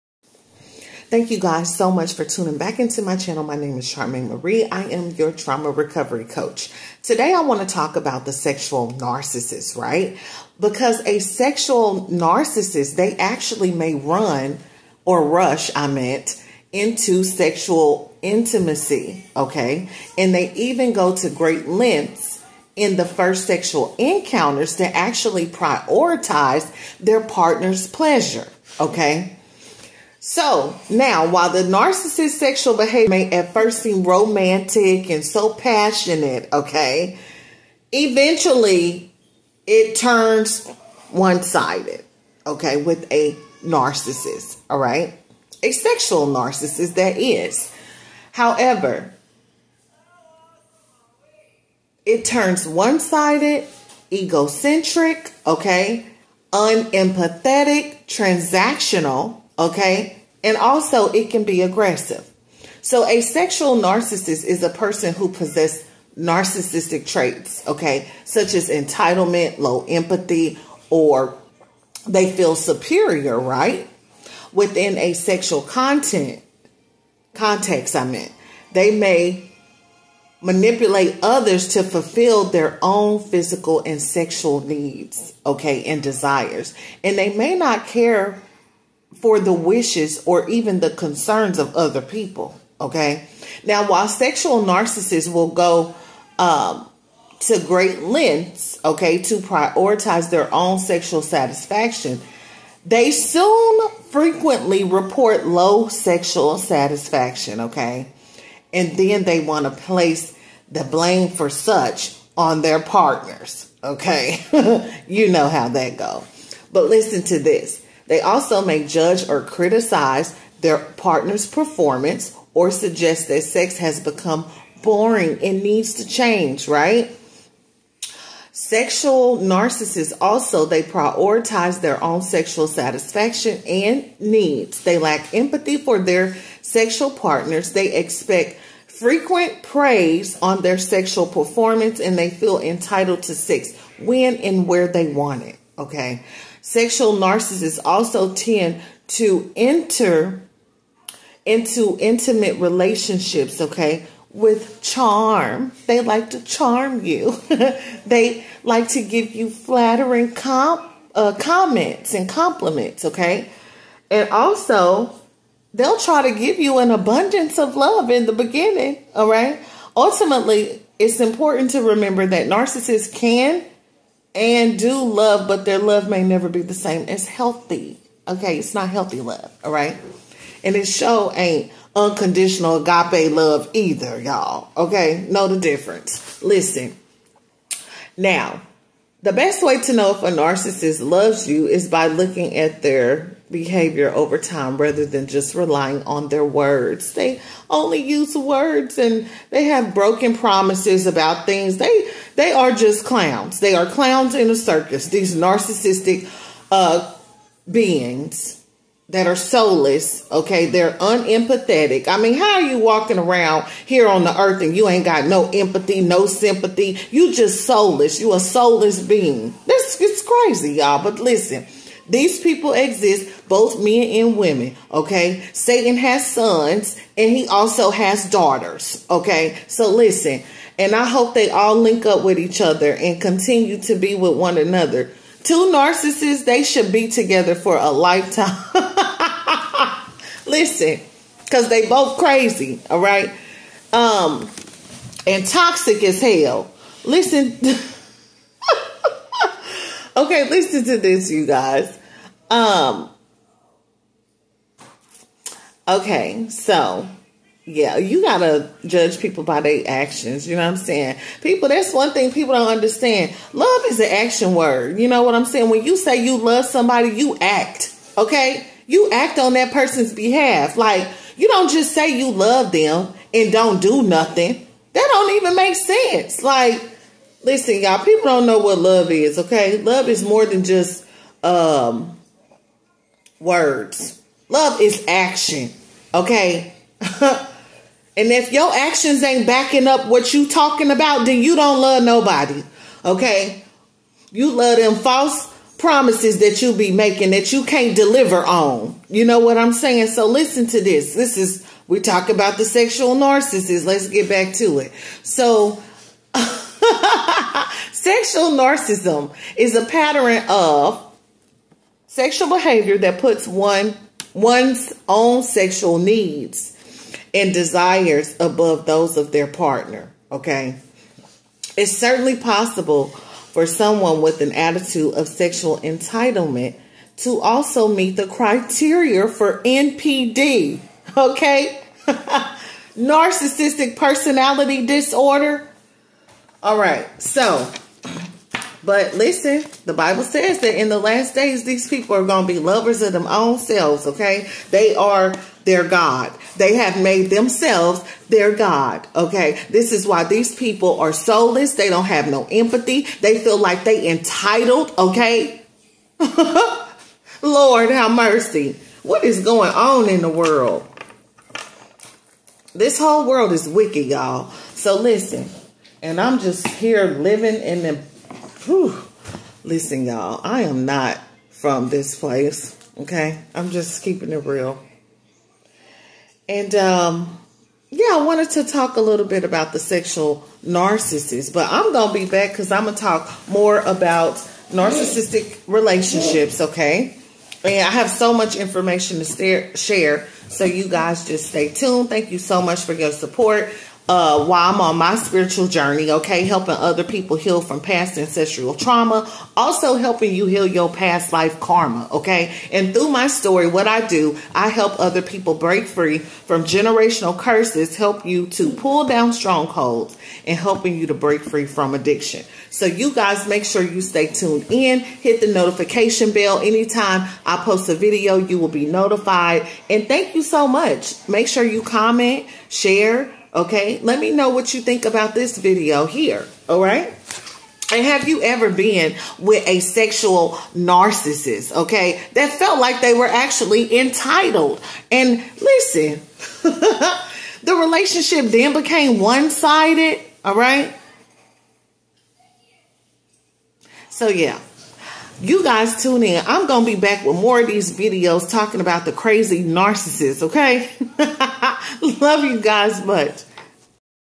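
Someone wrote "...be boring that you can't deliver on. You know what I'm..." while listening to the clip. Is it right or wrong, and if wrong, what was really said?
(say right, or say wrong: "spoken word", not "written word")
wrong: "making", not "boring".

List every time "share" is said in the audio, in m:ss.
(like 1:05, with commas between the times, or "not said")
6:29, 7:02.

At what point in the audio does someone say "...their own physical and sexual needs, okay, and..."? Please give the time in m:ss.
1:22.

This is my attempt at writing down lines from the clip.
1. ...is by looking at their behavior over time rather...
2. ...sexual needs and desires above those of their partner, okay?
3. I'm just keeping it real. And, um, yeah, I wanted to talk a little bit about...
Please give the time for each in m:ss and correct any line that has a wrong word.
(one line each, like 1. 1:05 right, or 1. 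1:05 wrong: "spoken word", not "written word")
1. 3:11 right
2. 5:15 right
3. 6:13 right.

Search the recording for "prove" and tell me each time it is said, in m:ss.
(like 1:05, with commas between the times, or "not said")
not said.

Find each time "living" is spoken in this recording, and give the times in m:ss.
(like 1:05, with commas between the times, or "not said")
6:07.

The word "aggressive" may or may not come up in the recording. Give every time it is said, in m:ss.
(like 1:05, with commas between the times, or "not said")
1:01.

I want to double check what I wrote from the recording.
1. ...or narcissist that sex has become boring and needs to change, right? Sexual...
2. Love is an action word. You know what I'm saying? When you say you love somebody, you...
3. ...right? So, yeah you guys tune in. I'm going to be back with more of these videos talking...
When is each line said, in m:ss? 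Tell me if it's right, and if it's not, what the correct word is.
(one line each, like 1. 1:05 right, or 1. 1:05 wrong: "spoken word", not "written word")
1. 2:02 wrong: "suggest", not "narcissist"
2. 4:23 right
3. 7:20 right.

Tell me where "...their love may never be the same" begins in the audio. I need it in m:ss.
2:55.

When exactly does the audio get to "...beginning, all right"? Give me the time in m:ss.
2:48.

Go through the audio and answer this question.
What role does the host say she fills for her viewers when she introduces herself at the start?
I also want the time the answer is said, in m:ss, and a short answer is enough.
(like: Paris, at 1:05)
trauma recovery coach, at 0:05.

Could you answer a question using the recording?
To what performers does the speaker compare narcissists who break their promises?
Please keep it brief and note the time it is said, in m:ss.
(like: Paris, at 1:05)
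clowns in a circus, at 3:23.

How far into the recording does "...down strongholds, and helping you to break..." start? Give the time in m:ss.
6:49.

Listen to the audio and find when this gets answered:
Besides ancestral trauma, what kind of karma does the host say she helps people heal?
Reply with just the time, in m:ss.
6:40.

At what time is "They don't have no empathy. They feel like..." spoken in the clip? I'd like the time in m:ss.
5:51.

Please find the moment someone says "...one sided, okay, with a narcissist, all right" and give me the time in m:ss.
0:41.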